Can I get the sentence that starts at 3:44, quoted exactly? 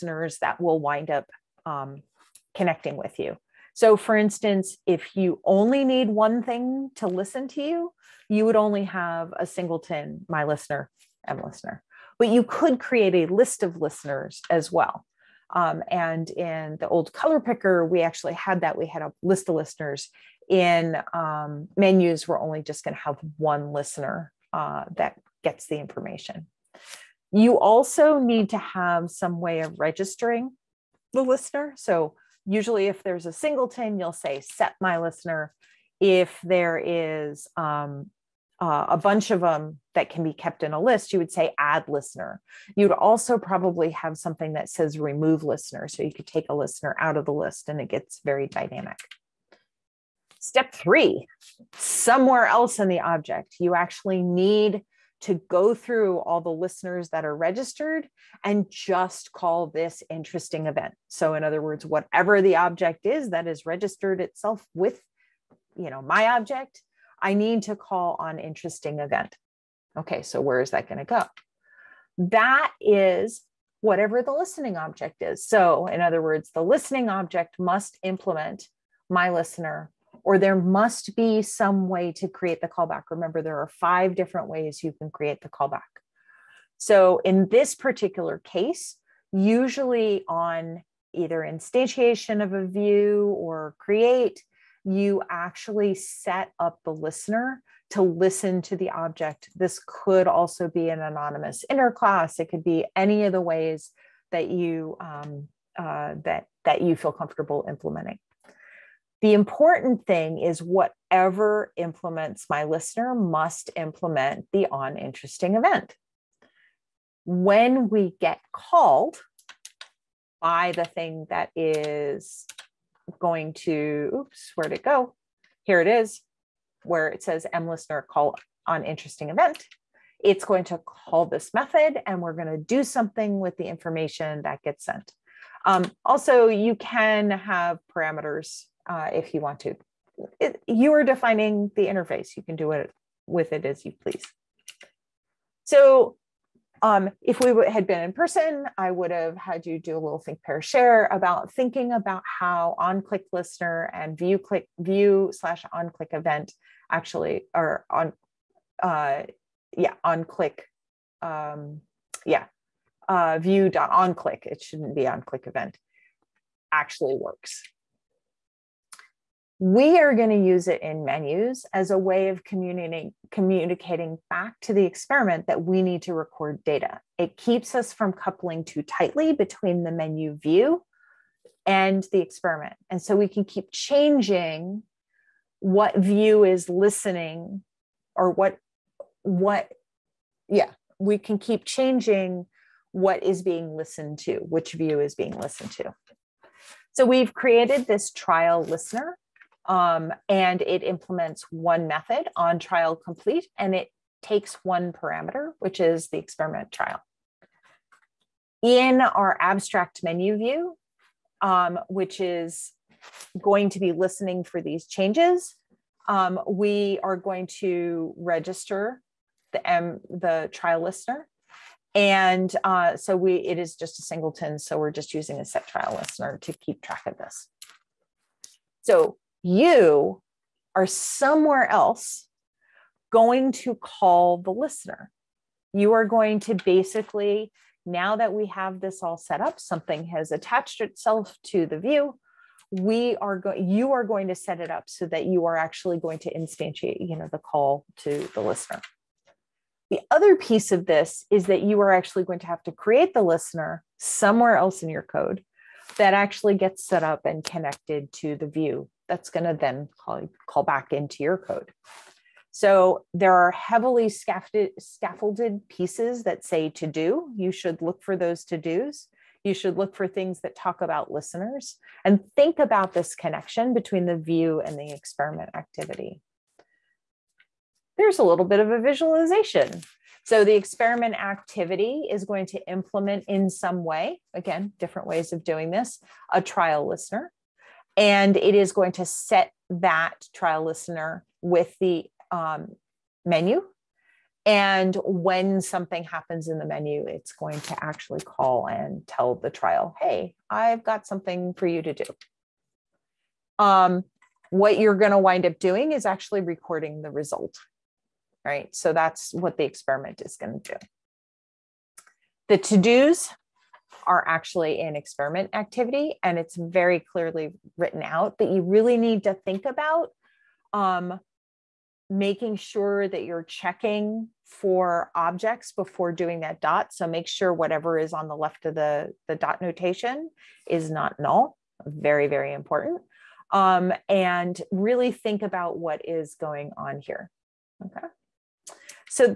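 So we're just using a set trial listener to keep track of this.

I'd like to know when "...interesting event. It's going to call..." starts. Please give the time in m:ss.
2:08.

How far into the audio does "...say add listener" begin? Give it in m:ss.
0:41.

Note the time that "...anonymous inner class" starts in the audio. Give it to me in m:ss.
1:40.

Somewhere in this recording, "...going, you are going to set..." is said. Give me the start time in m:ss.
4:03.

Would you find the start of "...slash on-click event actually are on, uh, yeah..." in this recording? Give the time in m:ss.
2:35.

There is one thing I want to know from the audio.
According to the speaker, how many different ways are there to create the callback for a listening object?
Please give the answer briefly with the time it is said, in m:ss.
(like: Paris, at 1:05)
5, at 1:23.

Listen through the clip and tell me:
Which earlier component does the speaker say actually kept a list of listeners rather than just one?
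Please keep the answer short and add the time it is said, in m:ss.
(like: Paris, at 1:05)
the old color picker, at 0:16.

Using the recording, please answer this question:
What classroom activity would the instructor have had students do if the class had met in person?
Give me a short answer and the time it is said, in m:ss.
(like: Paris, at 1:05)
think, pair, share, at 2:30.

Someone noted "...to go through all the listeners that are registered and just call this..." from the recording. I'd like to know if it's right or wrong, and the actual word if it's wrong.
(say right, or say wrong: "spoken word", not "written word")
right.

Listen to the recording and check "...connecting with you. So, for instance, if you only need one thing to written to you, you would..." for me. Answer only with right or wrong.
wrong.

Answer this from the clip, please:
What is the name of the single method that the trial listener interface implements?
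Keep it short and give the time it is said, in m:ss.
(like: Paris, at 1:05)
on trial complete, at 3:22.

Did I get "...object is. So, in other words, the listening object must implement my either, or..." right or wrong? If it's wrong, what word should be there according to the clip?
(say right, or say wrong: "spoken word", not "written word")
wrong: "listener", not "either".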